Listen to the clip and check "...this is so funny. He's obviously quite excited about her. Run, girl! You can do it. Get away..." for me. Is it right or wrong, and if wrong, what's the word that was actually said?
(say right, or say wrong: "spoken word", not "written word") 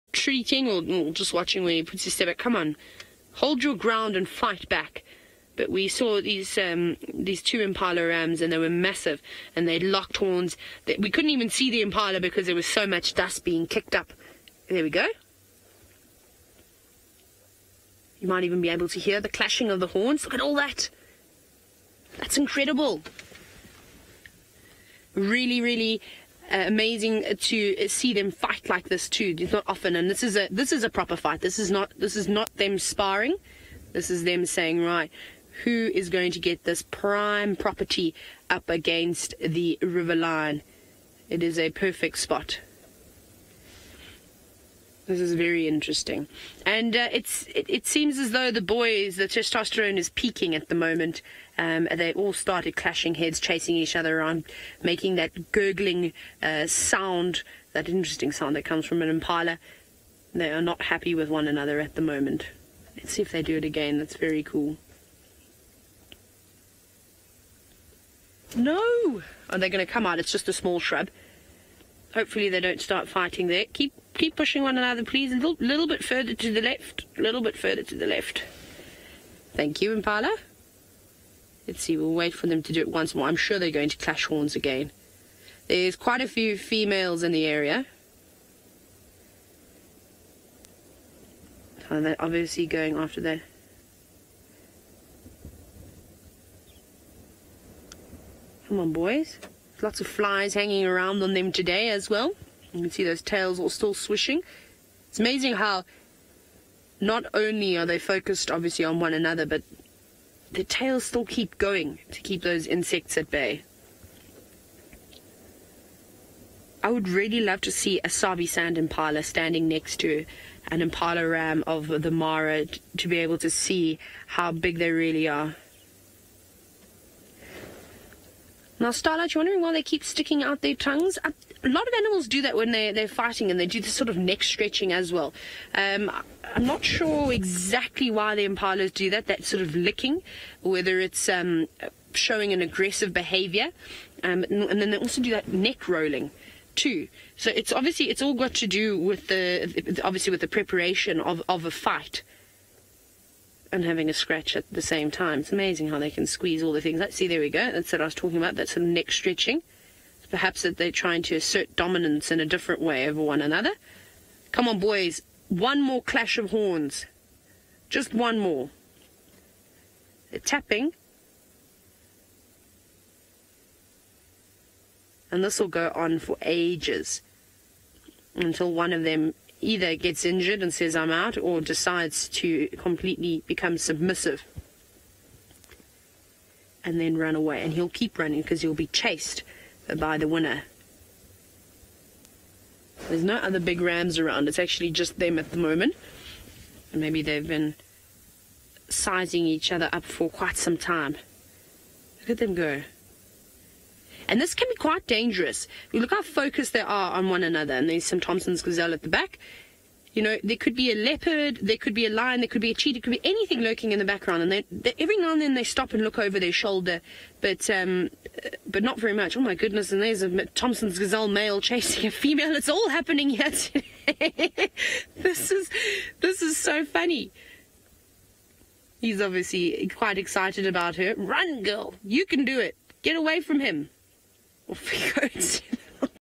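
right.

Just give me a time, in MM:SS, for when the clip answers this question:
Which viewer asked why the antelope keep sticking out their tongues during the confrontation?
02:08.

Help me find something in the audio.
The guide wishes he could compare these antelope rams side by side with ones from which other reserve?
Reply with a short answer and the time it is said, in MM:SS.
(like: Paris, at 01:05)
Sabi Sand, at 01:58.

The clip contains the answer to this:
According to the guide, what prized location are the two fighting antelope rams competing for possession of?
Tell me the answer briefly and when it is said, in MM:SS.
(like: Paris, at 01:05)
Prime property up against the river line, at 00:36.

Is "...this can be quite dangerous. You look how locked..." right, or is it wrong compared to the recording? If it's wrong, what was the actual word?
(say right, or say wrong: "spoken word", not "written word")
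wrong: "focused", not "locked".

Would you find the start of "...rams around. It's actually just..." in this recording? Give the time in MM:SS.
03:13.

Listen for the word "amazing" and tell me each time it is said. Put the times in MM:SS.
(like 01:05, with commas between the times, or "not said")
00:26, 01:45, 02:35.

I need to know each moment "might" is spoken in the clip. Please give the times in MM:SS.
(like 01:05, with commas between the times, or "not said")
00:18.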